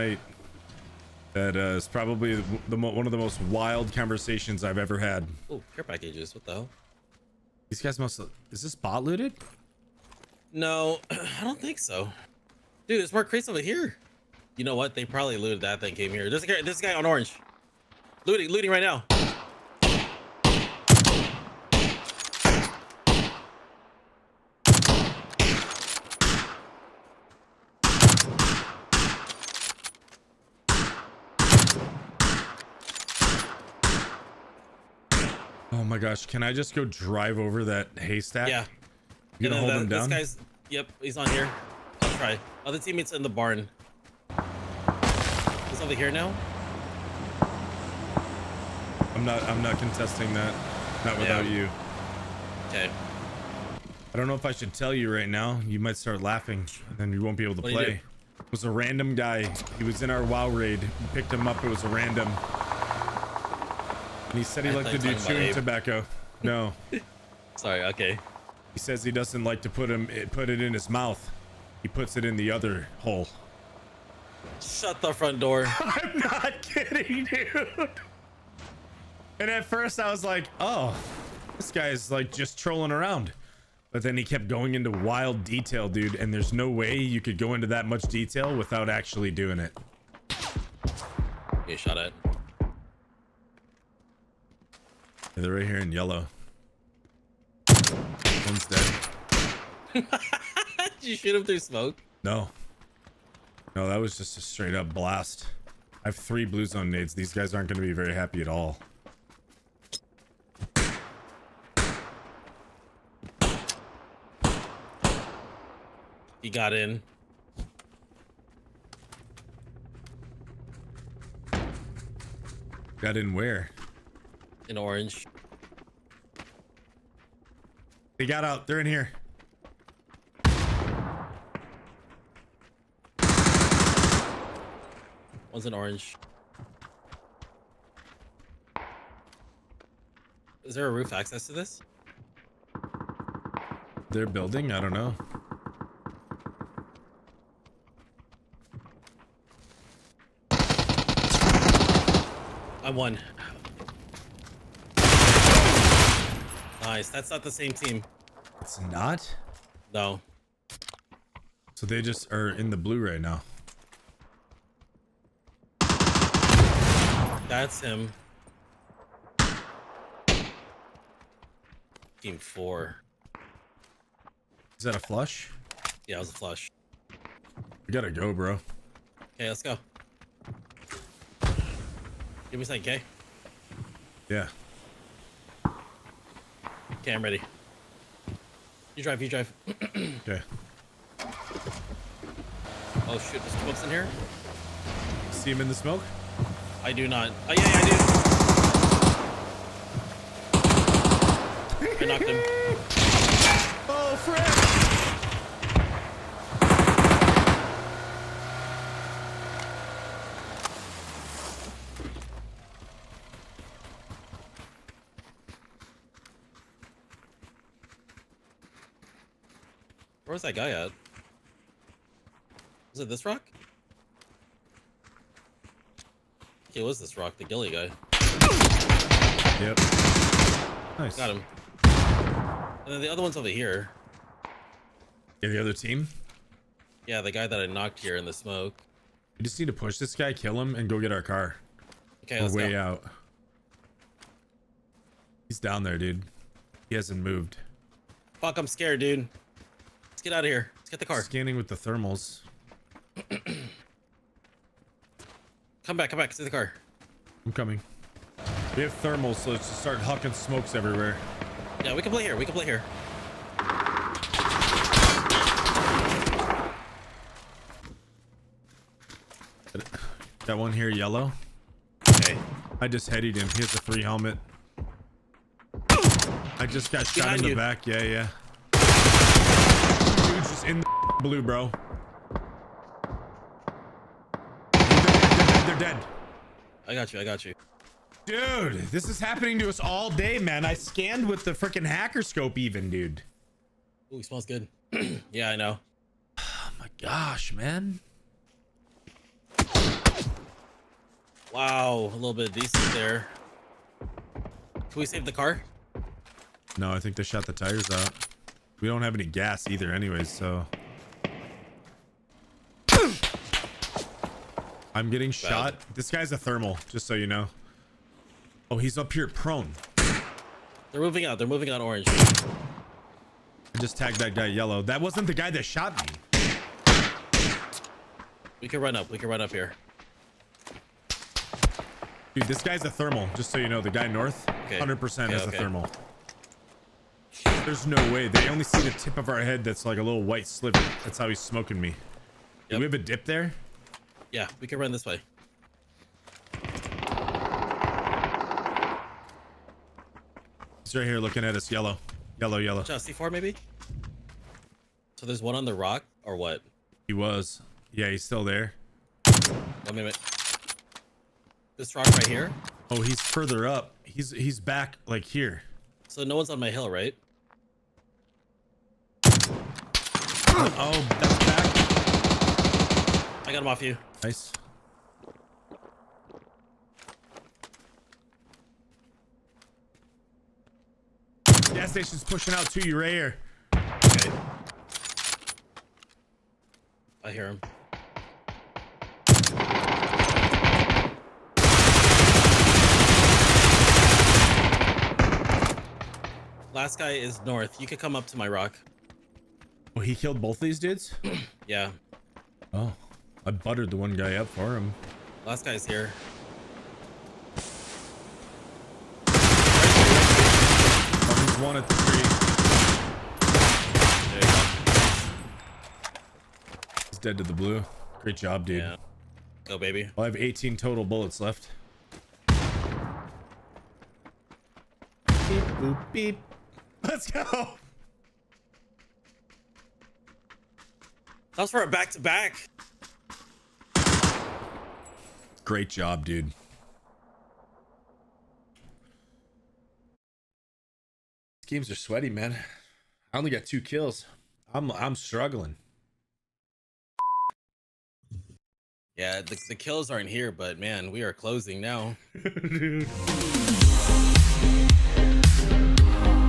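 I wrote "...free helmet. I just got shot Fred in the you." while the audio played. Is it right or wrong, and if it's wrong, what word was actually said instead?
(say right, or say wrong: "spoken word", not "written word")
wrong: "Behind", not "Fred".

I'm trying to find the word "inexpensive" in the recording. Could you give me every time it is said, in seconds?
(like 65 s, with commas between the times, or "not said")
not said.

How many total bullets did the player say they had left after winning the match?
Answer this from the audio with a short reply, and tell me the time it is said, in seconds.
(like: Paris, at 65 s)
18, at 420 s.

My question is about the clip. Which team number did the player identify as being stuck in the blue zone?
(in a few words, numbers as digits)
Team 4.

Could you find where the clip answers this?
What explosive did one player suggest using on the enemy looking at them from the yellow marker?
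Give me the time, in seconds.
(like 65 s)
353 s.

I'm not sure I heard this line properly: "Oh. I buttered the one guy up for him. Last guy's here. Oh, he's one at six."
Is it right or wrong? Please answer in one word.
wrong.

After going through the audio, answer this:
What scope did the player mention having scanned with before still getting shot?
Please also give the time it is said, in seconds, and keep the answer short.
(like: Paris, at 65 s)
Hacker scope, at 291 s.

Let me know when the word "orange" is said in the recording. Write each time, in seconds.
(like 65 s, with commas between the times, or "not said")
17 s, 124 s, 135 s, 321 s.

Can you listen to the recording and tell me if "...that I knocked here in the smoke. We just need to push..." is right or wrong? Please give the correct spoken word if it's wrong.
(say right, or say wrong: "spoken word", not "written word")
right.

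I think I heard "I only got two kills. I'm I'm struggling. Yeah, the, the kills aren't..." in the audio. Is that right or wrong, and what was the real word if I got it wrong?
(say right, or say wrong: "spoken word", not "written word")
right.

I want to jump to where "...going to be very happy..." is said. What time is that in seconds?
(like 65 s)
107 s.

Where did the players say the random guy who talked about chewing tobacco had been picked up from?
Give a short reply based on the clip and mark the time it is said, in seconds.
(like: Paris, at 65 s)
WoW raid, at 60 s.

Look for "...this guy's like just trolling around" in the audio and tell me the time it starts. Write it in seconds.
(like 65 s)
81 s.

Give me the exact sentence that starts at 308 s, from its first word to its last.
We don't have any gas either anyways, so.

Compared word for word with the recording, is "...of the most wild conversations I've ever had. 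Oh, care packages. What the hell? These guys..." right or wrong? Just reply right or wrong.
right.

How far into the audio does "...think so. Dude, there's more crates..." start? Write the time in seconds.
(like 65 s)
11 s.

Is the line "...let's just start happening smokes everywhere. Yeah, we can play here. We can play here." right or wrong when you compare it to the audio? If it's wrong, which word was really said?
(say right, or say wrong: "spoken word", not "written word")
wrong: "hucking", not "happening".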